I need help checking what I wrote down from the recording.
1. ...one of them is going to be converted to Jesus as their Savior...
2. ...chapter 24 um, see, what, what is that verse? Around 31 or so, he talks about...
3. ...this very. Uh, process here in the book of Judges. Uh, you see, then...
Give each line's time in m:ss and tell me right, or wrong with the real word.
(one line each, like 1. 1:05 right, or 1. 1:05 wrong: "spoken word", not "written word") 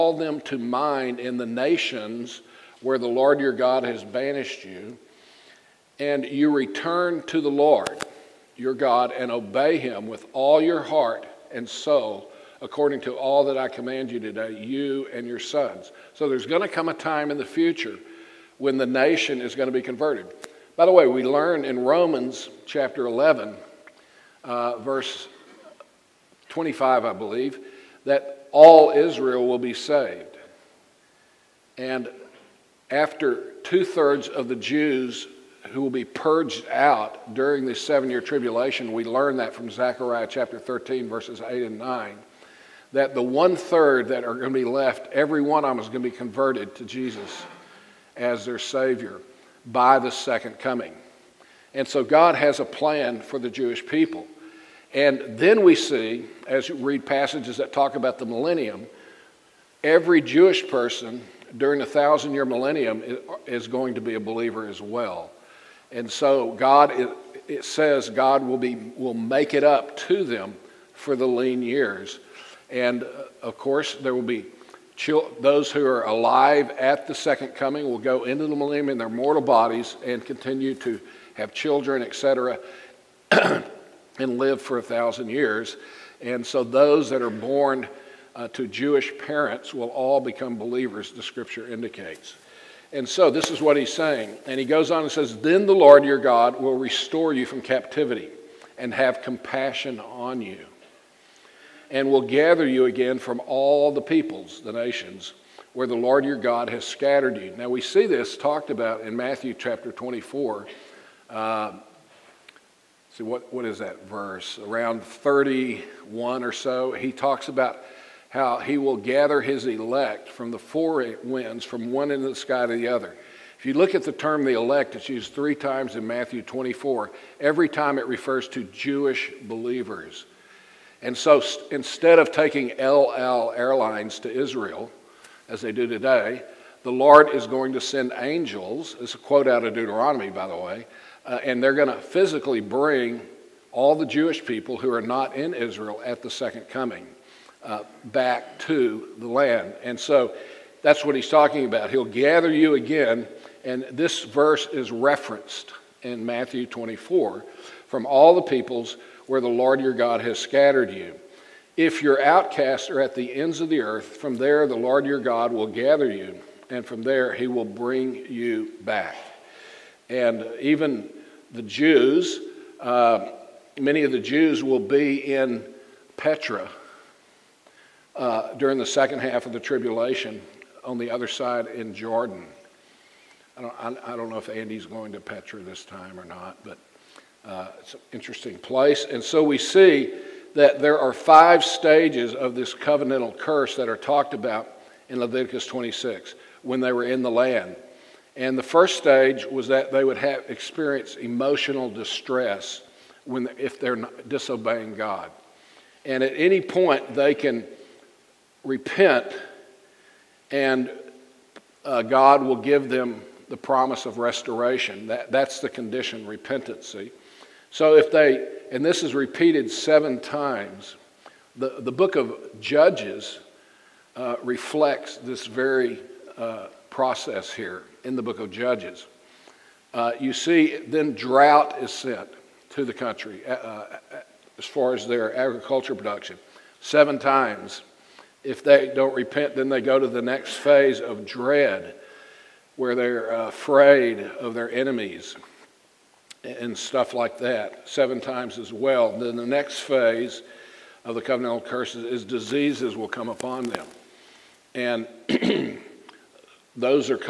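1. 0:45 right
2. 1:49 right
3. 3:45 right.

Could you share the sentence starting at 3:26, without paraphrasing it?
And at any point, they can repent, and uh, God will give them the promise of restoration.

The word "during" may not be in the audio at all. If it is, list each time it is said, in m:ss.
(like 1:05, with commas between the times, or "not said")
0:37, 1:01, 2:58.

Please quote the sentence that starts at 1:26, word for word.
And so those that are born uh, to Jewish parents will all become believers, the scripture indicates.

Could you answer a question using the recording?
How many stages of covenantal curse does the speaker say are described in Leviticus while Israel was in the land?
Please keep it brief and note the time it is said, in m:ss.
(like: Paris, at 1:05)
5, at 3:11.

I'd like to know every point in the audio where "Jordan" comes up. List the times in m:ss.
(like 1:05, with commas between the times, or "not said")
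3:01.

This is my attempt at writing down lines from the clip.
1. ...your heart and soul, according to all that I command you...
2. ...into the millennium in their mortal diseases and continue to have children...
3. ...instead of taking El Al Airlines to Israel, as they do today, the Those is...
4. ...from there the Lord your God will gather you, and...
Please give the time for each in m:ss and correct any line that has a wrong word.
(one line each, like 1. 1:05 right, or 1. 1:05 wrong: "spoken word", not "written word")
1. 0:10 right
2. 1:18 wrong: "bodies", not "diseases"
3. 2:11 wrong: "Lord", not "Those"
4. 2:44 right.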